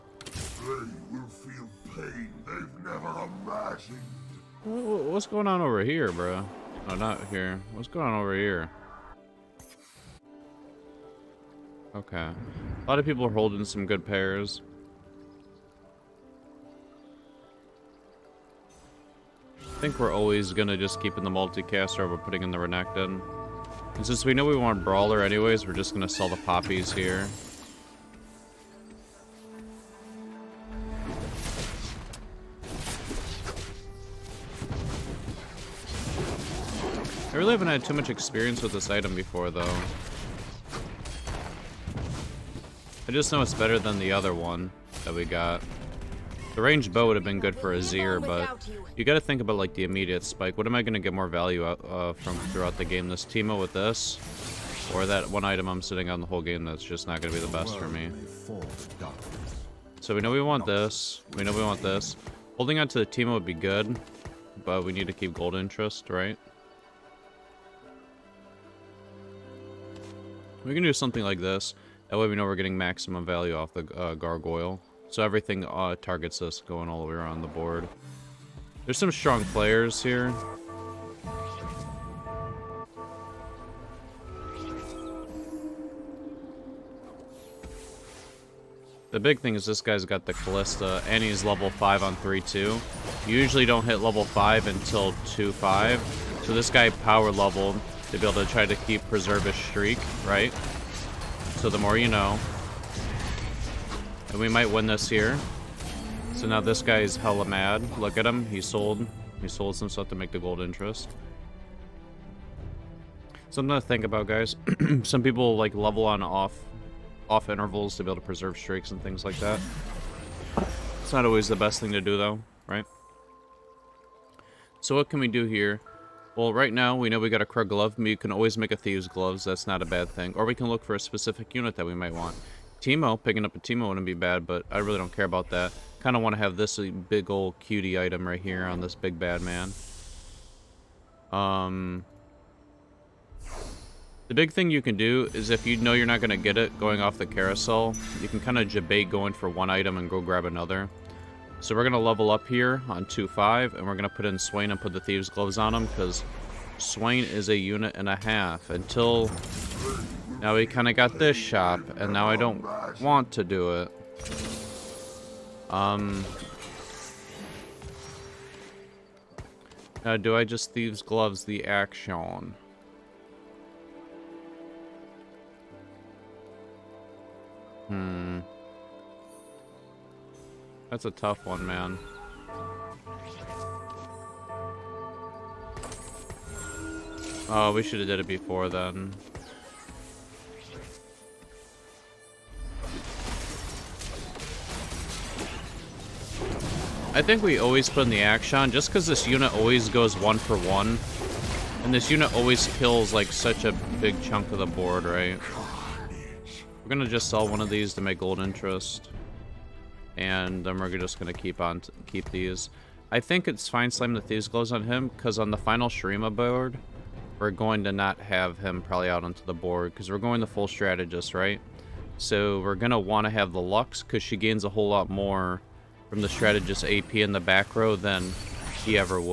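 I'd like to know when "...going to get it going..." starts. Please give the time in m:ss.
2:26.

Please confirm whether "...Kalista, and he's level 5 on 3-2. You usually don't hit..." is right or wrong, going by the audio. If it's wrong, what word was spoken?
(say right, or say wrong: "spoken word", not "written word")
right.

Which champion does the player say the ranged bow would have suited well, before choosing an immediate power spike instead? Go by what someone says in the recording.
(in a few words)
Azir.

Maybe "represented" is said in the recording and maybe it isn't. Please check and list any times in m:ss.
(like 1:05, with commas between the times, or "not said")
not said.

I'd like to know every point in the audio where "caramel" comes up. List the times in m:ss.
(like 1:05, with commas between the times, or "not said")
not said.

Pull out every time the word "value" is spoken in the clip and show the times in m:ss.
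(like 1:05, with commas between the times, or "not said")
0:51, 1:13.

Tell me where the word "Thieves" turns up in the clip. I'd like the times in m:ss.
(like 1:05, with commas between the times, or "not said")
2:08, 2:34, 2:50, 3:34.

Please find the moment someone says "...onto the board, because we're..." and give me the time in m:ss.
3:39.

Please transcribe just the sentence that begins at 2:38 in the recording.
Until now we kind of got this shop, and now I don't want to do it.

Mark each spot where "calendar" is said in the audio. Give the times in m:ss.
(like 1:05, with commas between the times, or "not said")
not said.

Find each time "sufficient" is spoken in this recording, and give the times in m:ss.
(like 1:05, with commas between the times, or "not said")
not said.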